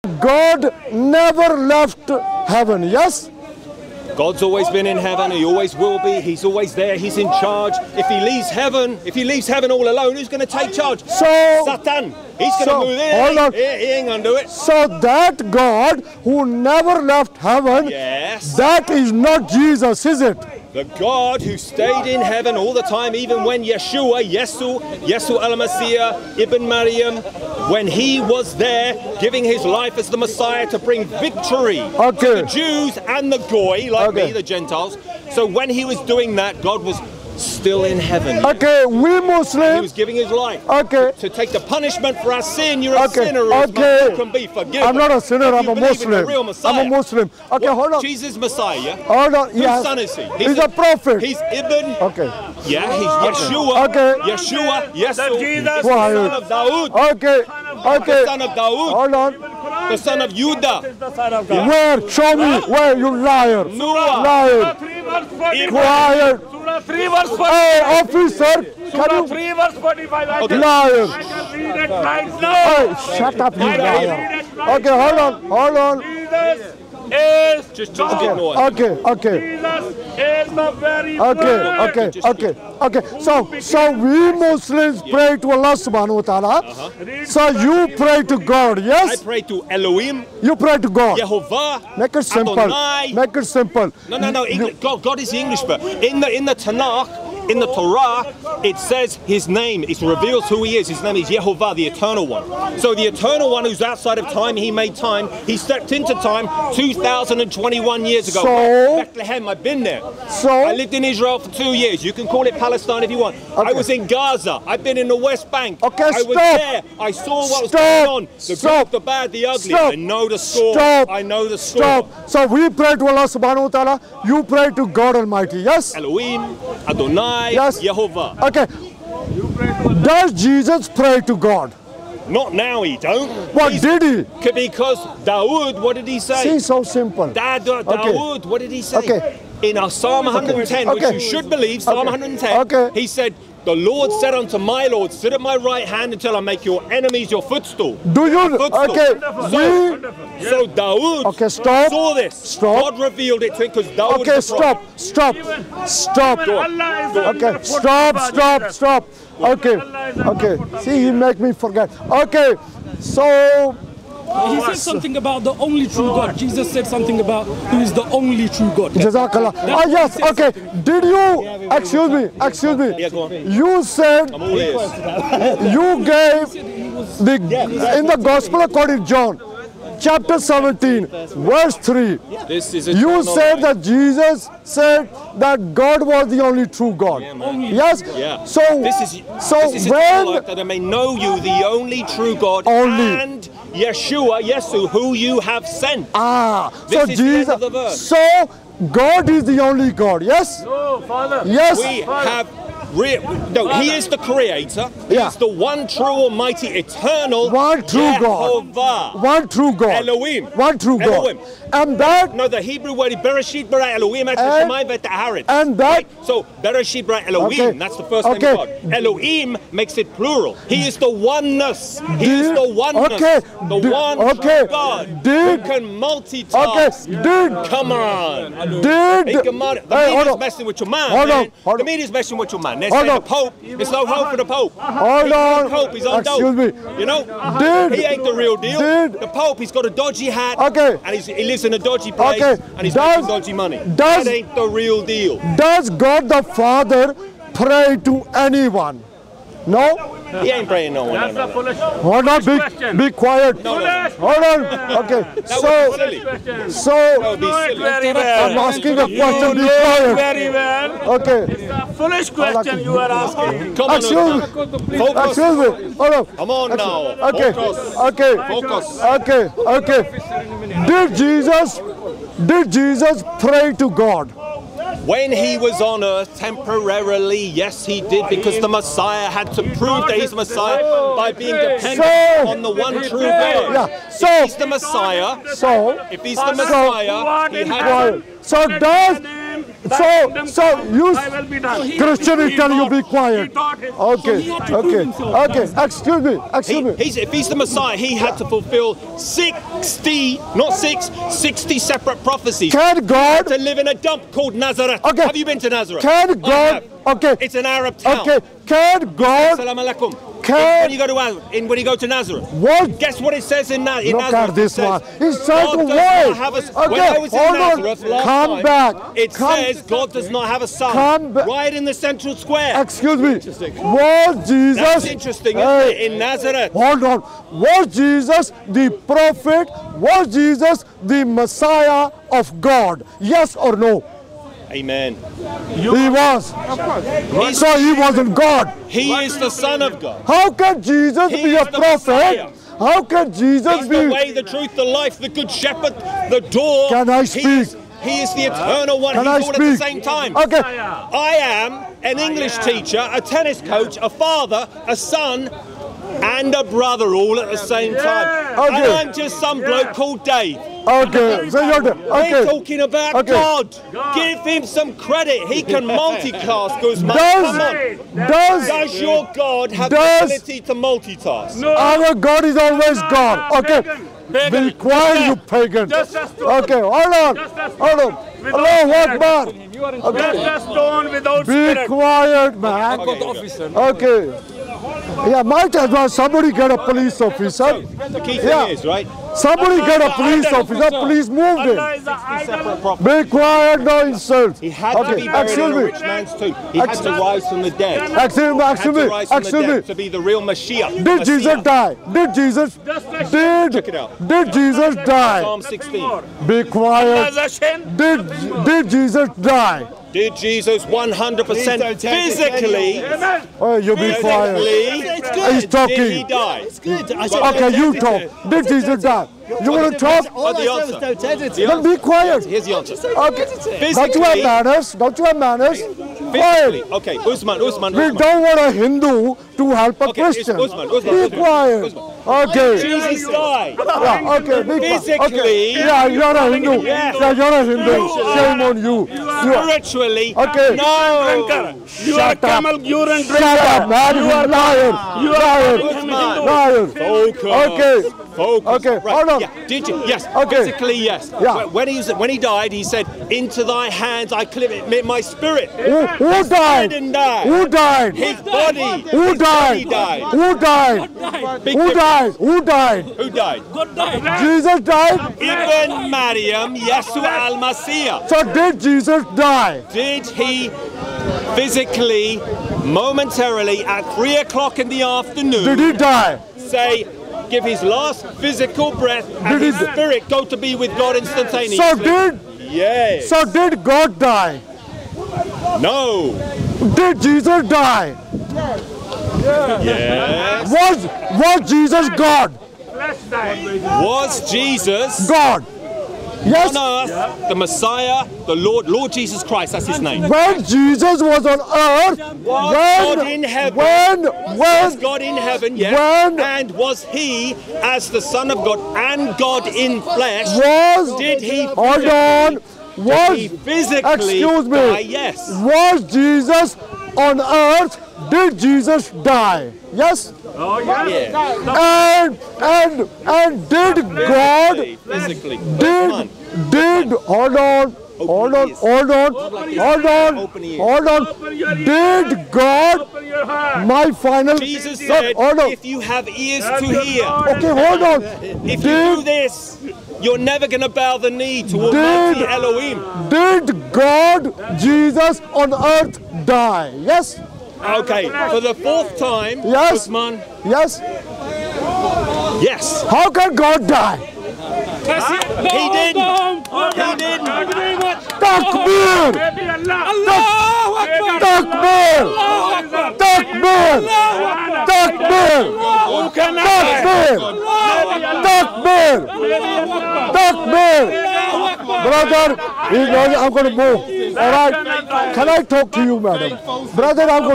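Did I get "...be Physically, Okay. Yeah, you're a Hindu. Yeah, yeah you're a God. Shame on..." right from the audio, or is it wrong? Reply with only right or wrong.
wrong.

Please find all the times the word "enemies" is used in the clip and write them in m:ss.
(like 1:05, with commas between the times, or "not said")
2:26.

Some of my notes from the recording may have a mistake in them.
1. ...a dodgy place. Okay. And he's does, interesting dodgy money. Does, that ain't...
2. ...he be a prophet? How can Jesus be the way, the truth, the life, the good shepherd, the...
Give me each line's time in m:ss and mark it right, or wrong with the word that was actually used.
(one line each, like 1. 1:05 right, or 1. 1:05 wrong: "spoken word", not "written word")
1. 4:01 wrong: "making", not "interesting"
2. 5:41 right.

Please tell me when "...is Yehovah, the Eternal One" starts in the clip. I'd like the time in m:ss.
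1:41.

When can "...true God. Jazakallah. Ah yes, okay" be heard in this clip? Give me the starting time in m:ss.
2:48.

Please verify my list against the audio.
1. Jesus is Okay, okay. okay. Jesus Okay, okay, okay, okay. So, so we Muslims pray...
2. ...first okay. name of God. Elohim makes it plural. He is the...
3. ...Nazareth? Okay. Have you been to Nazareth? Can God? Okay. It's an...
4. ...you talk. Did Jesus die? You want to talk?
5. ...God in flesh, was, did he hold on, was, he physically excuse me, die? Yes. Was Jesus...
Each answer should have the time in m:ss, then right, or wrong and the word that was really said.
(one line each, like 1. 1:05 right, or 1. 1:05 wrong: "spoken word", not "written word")
1. 1:16 right
2. 3:38 right
3. 5:04 right
4. 6:57 right
5. 8:29 right.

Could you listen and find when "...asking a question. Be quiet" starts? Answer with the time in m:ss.
4:18.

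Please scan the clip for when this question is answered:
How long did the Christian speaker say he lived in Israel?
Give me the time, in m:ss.
1:51.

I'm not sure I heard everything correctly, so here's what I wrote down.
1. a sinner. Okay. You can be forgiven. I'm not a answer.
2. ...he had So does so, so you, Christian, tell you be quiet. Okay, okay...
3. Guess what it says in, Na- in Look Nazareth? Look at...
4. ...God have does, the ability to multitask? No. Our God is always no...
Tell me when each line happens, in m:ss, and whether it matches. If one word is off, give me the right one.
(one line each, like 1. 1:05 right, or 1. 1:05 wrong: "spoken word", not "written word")
1. 0:43 wrong: "sinner", not "answer"
2. 4:47 right
3. 5:12 right
4. 6:09 right.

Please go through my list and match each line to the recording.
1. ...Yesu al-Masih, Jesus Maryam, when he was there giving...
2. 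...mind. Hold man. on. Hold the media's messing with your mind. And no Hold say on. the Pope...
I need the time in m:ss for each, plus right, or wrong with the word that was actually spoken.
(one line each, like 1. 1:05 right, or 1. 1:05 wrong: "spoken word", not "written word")
1. 0:25 wrong: "Ibn", not "Jesus"
2. 3:50 right.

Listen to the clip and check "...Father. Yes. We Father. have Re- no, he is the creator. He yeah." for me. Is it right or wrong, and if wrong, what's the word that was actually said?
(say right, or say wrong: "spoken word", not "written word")
right.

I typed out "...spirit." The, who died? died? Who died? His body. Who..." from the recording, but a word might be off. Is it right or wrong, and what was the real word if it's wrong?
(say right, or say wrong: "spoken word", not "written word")
wrong: "Who", not "The".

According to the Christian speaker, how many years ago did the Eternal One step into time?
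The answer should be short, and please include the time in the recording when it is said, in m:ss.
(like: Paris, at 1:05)
2,021, at 1:46.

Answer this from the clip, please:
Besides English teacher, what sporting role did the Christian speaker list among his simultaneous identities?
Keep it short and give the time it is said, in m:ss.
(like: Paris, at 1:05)
tennis coach, at 5:53.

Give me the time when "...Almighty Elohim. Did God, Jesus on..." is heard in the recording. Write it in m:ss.
9:01.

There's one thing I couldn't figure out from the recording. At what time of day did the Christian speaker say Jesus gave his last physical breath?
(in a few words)
three o'clock in the afternoon.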